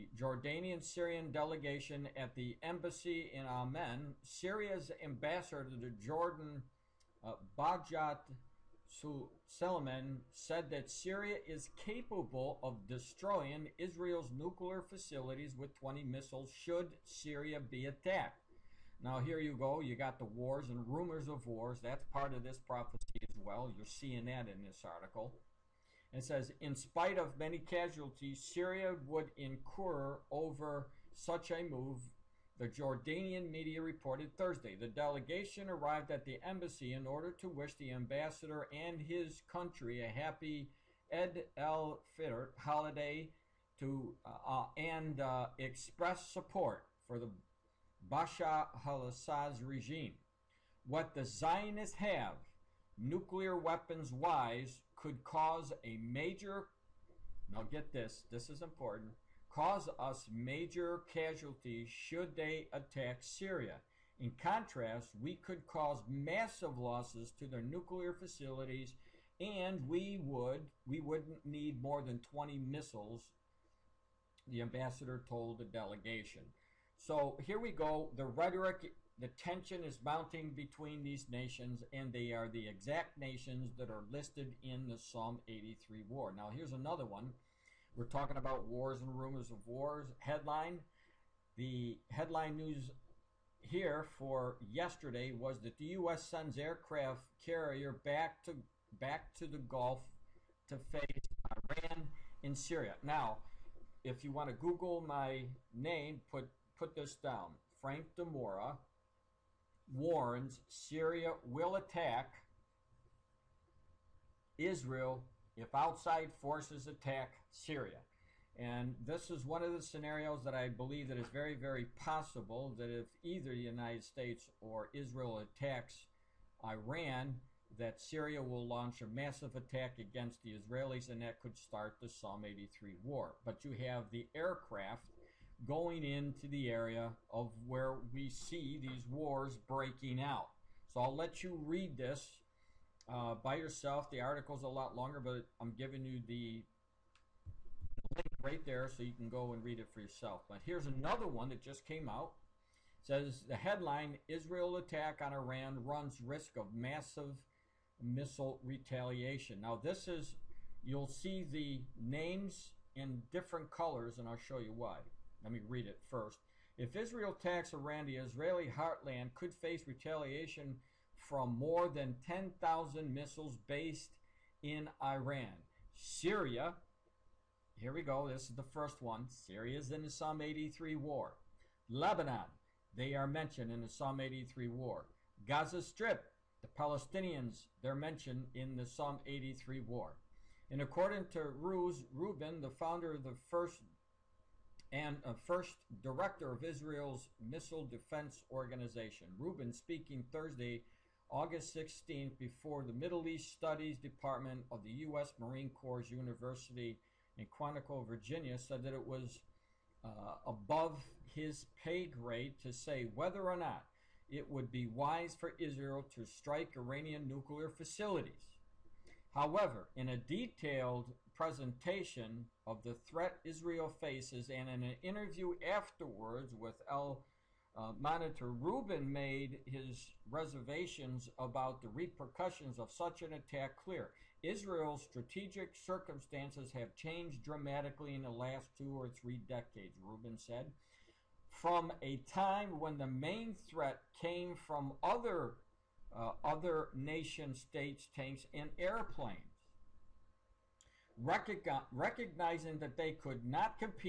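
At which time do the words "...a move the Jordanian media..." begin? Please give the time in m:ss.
0:31.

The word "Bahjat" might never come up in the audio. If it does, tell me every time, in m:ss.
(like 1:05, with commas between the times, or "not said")
0:07.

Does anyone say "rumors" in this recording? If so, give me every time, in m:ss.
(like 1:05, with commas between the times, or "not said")
0:20, 1:29.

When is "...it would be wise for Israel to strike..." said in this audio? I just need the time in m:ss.
3:34.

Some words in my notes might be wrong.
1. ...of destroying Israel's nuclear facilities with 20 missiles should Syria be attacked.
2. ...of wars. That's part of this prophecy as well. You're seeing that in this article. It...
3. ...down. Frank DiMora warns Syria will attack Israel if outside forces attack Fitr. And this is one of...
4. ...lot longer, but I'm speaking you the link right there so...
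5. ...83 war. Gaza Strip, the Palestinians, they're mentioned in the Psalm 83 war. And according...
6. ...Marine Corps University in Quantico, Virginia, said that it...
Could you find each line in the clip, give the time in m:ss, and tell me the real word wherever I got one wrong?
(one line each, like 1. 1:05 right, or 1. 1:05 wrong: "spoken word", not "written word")
1. 0:12 right
2. 0:21 right
3. 1:47 wrong: "Syria", not "Fitr"
4. 2:24 wrong: "giving", not "speaking"
5. 3:04 right
6. 3:25 right.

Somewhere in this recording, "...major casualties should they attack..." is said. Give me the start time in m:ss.
1:00.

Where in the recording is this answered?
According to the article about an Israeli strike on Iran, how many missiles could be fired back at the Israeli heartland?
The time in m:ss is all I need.
2:52.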